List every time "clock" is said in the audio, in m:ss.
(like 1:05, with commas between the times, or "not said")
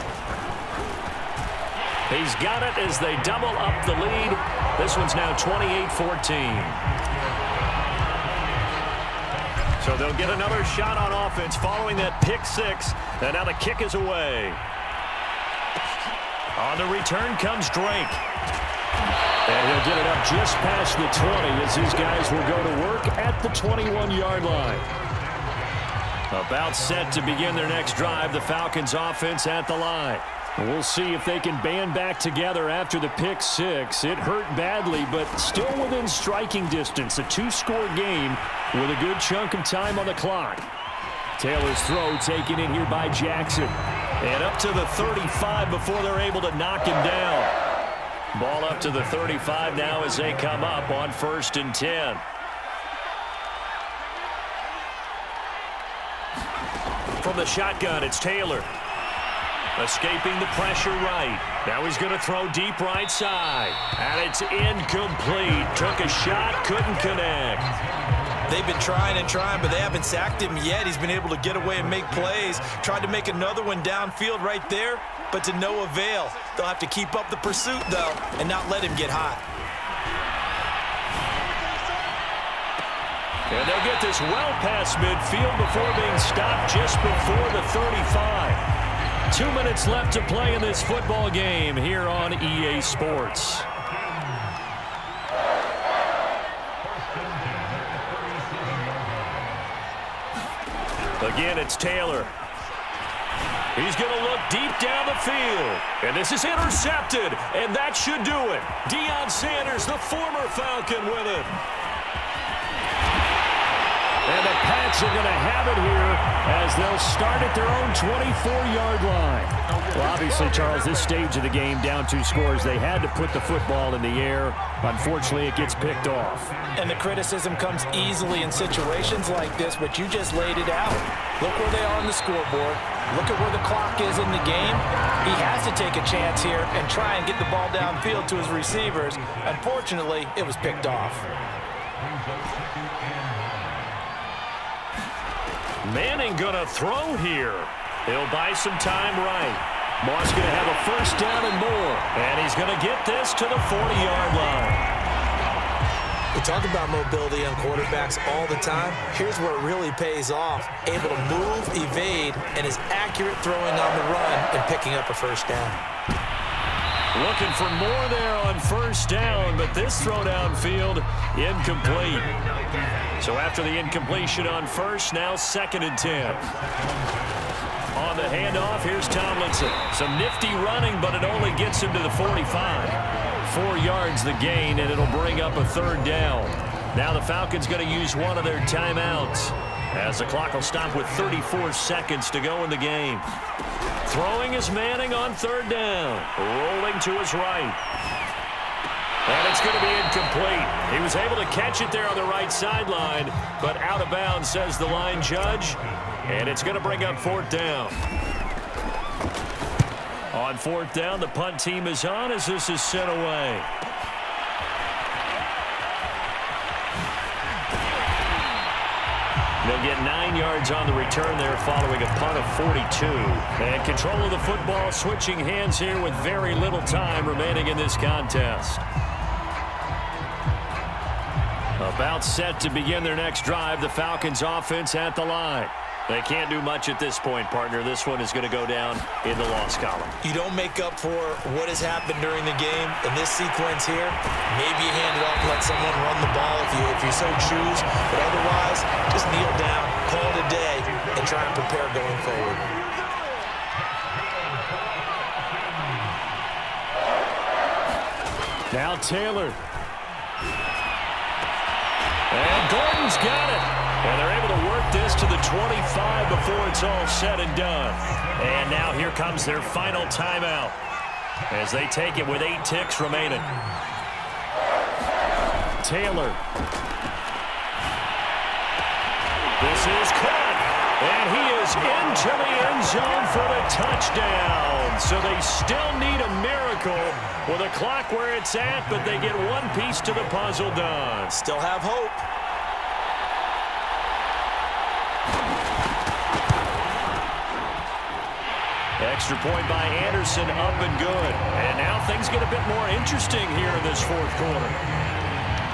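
0:40, 2:13, 3:10, 4:47.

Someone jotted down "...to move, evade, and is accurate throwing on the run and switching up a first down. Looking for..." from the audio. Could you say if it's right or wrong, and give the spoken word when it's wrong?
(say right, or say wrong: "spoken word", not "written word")
wrong: "picking", not "switching".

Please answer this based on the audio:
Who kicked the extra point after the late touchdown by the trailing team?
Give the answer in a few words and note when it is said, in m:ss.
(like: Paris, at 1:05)
Anderson, at 5:00.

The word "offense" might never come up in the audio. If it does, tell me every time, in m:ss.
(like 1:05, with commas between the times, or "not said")
0:11, 0:28, 3:54.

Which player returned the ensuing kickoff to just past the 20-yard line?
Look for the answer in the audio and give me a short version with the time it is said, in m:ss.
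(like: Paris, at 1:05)
Drake, at 0:17.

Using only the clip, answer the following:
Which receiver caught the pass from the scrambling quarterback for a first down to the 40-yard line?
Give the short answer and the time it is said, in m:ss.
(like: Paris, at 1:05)
Moss, at 2:30.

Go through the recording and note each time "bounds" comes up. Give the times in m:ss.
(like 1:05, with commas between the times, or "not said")
3:24.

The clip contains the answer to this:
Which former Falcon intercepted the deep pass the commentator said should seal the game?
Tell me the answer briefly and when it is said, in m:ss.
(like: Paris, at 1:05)
Deion Sanders, at 1:48.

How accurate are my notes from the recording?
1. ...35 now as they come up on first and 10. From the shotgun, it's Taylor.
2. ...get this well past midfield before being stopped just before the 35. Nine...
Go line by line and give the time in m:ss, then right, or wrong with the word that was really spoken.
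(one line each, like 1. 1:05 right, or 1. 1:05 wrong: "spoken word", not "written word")
1. 0:49 right
2. 1:23 wrong: "Two", not "Nine".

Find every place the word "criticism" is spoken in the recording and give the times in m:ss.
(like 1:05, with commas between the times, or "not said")
2:06.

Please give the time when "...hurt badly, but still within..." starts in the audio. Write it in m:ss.
0:34.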